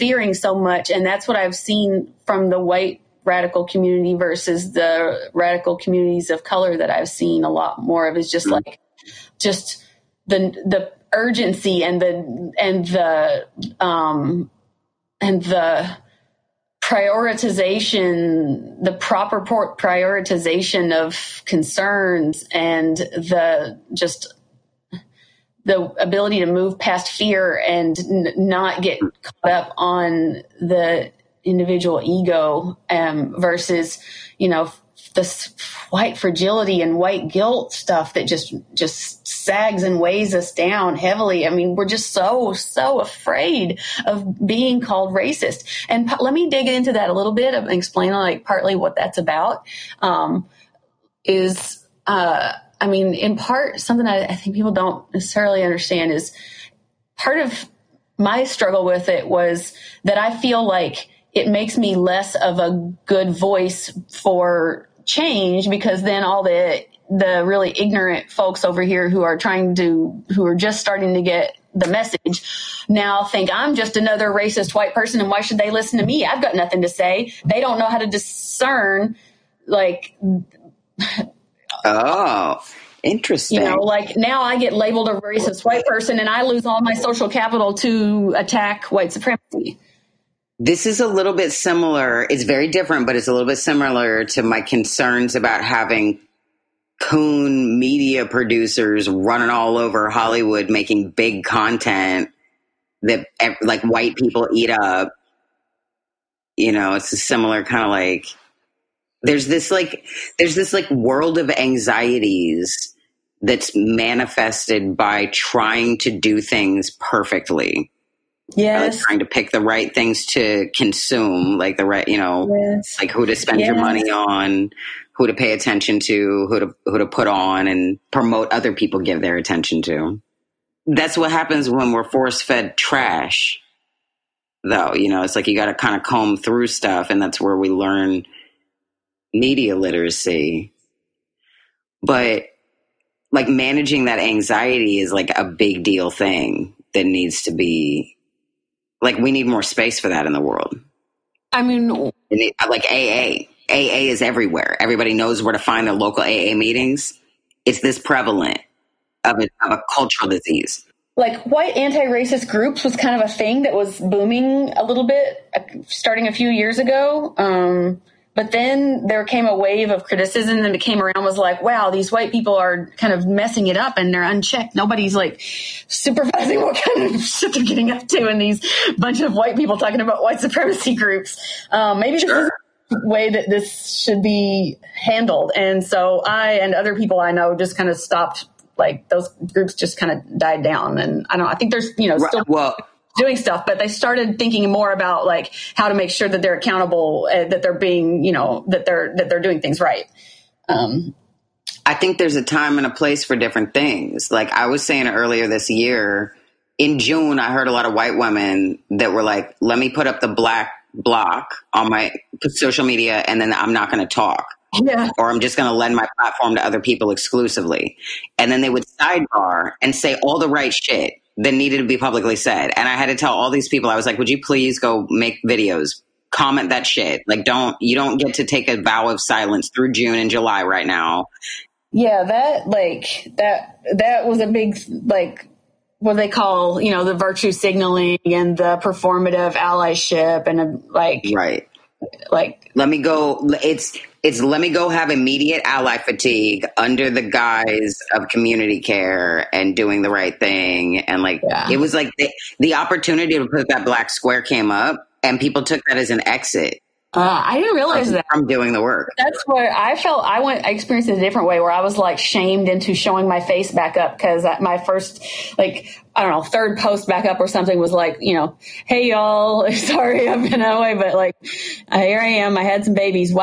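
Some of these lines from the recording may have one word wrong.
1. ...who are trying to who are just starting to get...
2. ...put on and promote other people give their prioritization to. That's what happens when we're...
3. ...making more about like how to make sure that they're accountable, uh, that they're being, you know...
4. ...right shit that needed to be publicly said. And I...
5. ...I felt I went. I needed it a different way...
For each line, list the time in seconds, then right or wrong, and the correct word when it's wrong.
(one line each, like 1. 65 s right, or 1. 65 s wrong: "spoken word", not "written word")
1. 69 s right
2. 127 s wrong: "attention", not "prioritization"
3. 194 s wrong: "thinking", not "making"
4. 220 s right
5. 259 s wrong: "experienced", not "needed".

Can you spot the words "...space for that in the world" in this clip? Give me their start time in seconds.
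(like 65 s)
149 s.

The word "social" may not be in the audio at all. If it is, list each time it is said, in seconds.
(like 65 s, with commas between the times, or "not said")
86 s, 212 s.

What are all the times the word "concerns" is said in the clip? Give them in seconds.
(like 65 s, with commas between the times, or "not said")
21 s, 94 s.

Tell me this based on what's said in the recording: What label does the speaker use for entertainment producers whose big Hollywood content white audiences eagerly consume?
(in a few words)
coon media producers.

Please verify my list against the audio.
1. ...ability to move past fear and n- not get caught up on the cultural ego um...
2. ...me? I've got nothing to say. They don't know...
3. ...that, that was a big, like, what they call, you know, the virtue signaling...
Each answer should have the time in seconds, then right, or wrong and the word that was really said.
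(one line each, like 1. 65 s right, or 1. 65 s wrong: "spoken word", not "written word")
1. 25 s wrong: "individual", not "cultural"
2. 76 s right
3. 233 s right.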